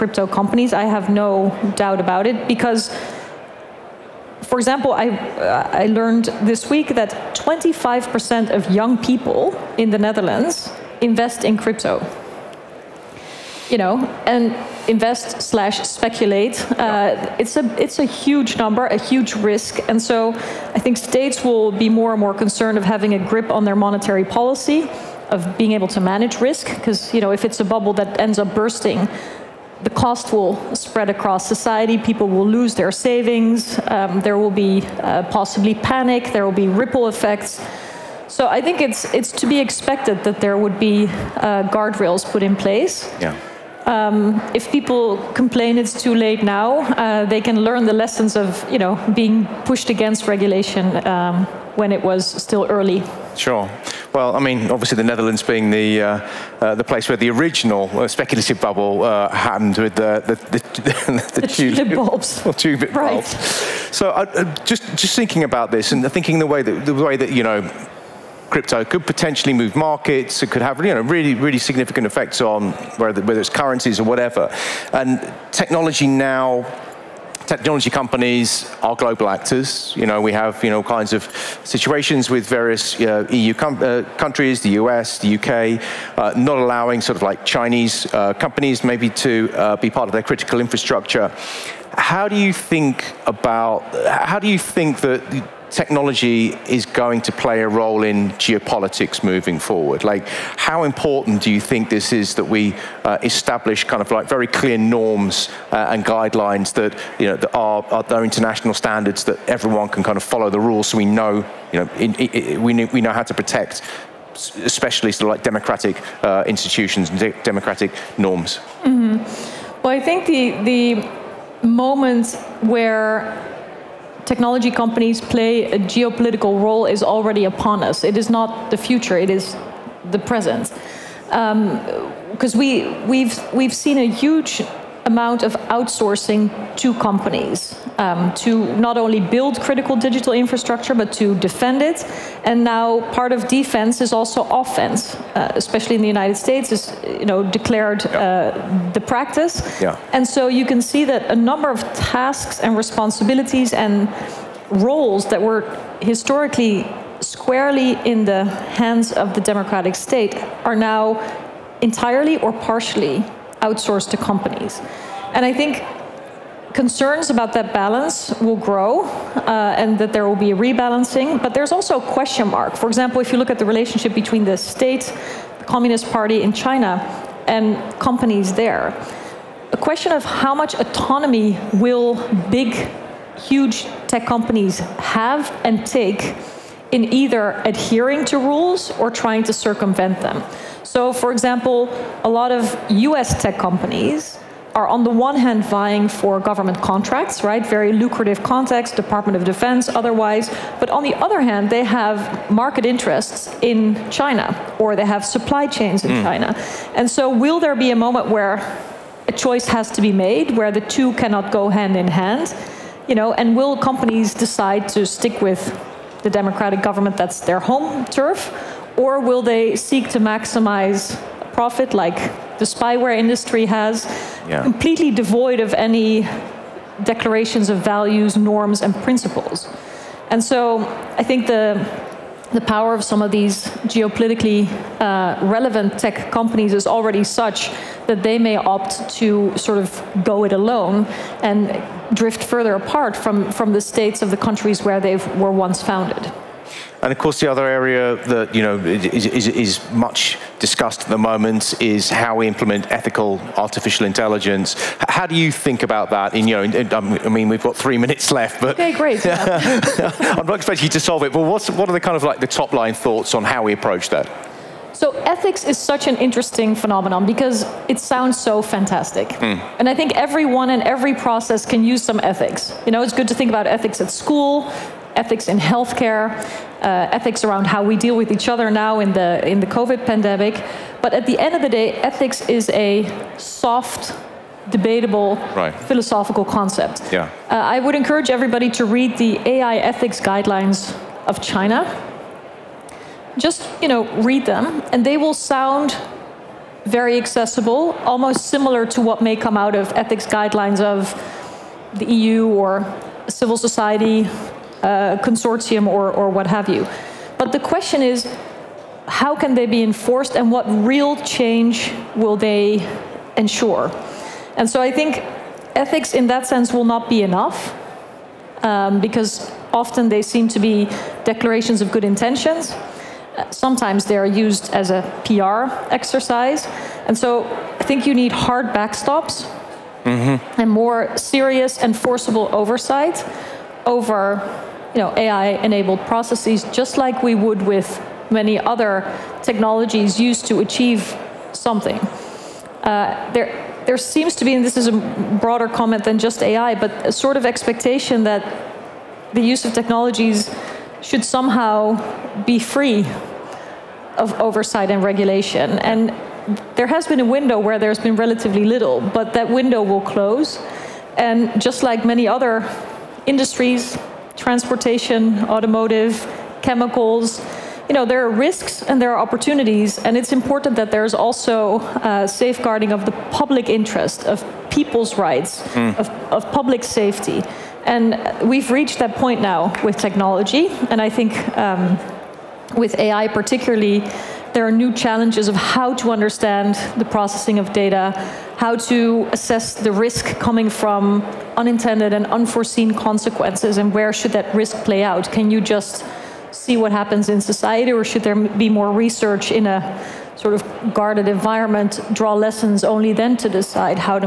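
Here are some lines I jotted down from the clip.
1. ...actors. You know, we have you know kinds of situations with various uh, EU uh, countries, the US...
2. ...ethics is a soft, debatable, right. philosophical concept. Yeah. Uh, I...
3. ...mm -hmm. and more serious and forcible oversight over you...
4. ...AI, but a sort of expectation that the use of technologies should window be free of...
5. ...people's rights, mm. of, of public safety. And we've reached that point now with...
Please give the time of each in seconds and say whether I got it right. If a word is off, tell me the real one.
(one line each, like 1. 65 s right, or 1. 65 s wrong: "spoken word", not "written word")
1. 79 s right
2. 281 s right
3. 330 s right
4. 346 s wrong: "somehow", not "window"
5. 374 s right.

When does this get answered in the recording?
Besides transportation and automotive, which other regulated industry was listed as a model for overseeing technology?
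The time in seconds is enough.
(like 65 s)
366 s.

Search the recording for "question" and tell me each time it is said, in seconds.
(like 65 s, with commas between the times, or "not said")
172 s, 179 s, 307 s.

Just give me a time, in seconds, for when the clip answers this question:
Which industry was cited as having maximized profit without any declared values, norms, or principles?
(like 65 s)
222 s.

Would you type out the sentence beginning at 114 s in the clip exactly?
Especially sort of like democratic uh, institutions and de democratic norms.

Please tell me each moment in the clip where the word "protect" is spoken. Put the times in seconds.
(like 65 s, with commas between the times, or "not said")
113 s.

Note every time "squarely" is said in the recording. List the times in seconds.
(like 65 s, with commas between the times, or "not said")
157 s.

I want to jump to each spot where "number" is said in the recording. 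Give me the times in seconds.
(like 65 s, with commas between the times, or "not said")
18 s, 151 s.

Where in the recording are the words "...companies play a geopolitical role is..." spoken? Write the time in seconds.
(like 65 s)
124 s.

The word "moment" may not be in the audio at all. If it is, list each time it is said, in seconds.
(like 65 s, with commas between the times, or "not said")
121 s, 207 s, 251 s.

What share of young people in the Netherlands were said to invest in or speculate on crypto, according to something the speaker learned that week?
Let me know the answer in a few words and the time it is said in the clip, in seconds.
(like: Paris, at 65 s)
25%, at 7 s.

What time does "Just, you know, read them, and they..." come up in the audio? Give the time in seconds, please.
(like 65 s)
293 s.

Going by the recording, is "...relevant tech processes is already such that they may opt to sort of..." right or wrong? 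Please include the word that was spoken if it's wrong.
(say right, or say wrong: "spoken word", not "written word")
wrong: "companies", not "processes".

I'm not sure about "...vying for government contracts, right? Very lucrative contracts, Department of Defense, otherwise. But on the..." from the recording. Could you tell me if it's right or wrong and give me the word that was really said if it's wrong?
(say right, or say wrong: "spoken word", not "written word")
right.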